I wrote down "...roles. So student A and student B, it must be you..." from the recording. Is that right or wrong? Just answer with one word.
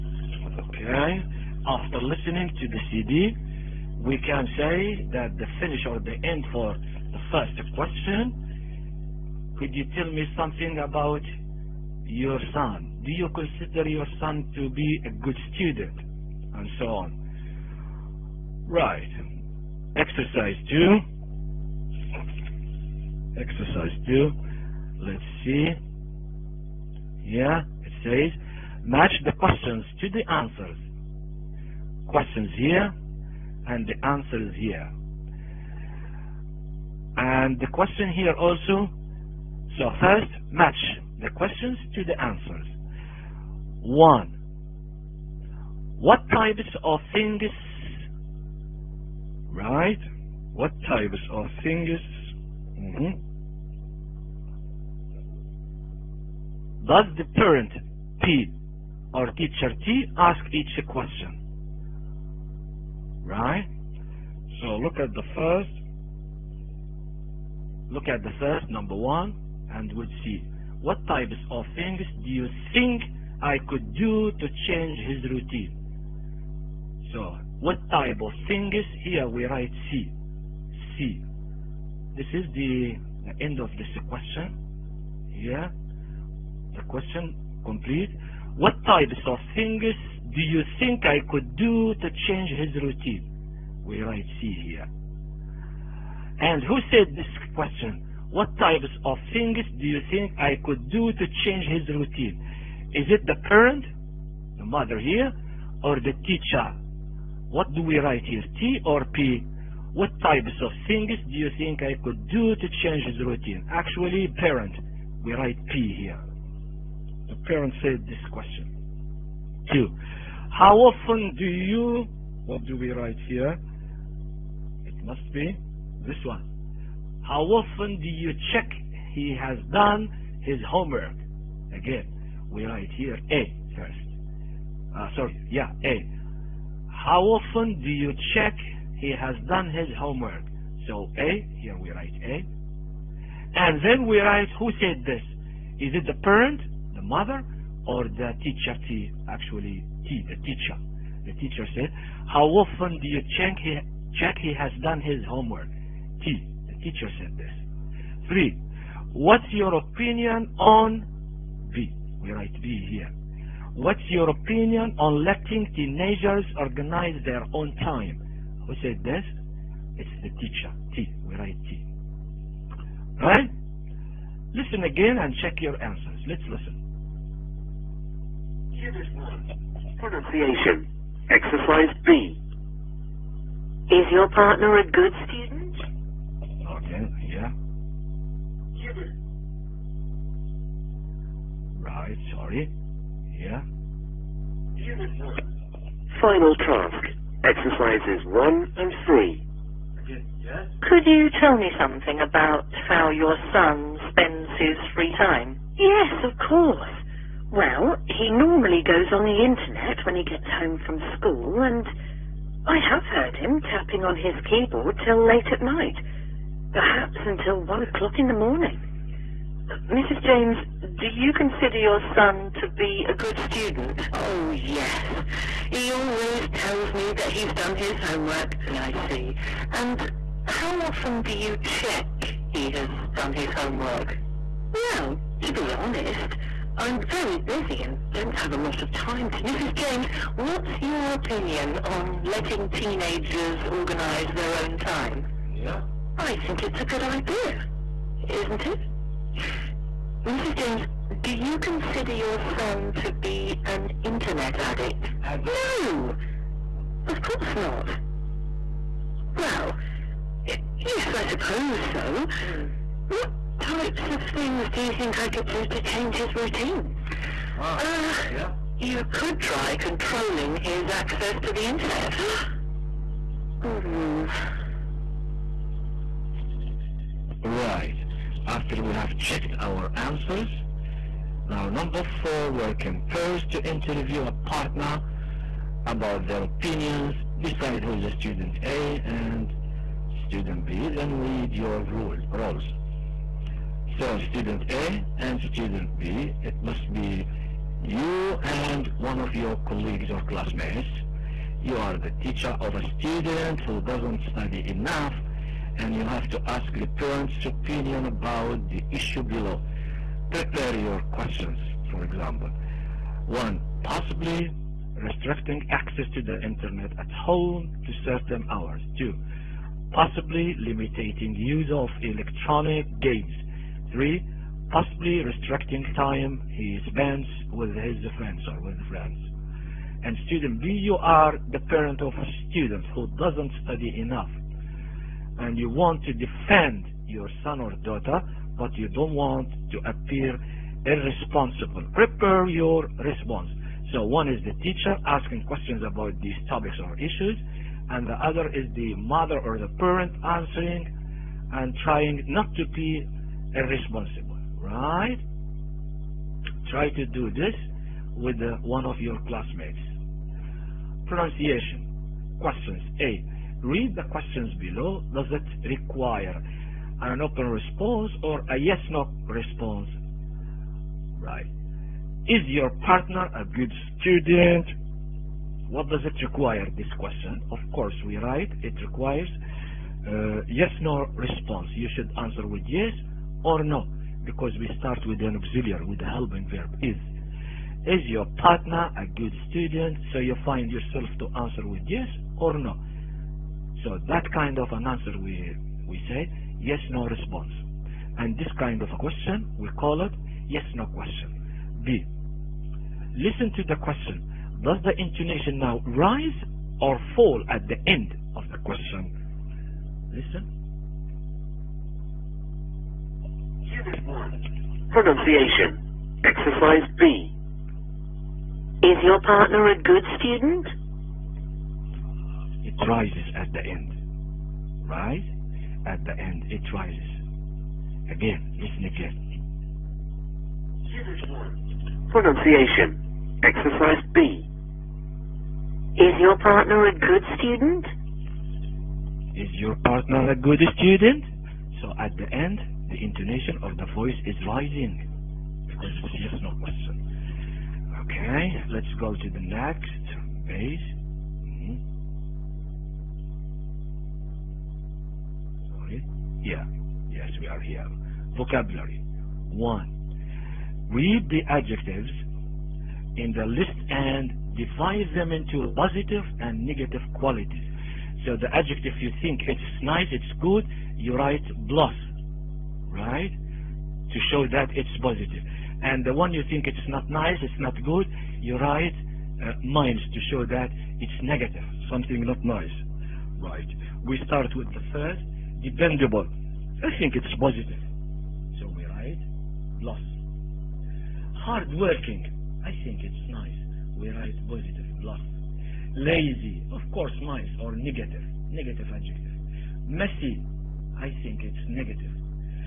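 right.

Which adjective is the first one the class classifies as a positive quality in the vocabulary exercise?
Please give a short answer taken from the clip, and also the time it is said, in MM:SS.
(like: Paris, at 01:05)
Dependable, at 08:05.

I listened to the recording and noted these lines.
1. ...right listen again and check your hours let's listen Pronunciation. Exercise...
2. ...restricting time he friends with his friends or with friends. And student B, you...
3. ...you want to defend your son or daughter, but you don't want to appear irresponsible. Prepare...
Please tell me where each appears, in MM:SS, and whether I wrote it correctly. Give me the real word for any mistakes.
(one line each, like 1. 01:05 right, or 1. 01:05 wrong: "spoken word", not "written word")
1. 02:53 wrong: "answers", not "hours"
2. 05:25 wrong: "spends", not "friends"
3. 05:35 right.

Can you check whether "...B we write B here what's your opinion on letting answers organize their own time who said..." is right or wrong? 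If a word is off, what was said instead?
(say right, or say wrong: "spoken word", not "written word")
wrong: "teenagers", not "answers".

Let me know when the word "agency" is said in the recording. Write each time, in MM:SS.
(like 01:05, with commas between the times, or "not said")
not said.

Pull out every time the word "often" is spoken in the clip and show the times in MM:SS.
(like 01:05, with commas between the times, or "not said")
02:00, 02:07, 02:17, 02:32, 03:50.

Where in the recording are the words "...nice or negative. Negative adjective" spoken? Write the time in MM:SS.
08:17.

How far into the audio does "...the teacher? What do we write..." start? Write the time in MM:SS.
01:45.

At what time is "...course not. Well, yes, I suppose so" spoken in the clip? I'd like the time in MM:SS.
04:17.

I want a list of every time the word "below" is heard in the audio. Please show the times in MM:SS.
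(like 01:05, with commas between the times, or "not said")
05:09, 06:04.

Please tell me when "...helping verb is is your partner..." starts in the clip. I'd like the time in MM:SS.
06:26.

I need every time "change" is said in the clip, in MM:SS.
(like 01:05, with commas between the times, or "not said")
01:14, 01:32, 01:41, 01:52, 04:25.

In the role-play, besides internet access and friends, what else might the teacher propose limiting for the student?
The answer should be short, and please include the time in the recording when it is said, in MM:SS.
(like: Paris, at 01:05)
Electronic games, at 05:22.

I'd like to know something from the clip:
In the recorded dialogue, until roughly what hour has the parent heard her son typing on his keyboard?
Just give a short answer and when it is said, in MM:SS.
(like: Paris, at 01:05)
1 a.m., at 03:37.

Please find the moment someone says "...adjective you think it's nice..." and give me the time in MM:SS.
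07:48.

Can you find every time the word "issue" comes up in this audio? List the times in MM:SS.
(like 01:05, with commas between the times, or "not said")
05:08, 05:46.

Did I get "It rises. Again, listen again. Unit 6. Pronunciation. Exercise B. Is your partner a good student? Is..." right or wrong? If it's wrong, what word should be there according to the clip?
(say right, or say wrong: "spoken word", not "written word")
wrong: "1", not "6".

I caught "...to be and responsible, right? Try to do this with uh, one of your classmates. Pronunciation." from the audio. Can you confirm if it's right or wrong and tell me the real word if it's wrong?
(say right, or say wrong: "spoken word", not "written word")
right.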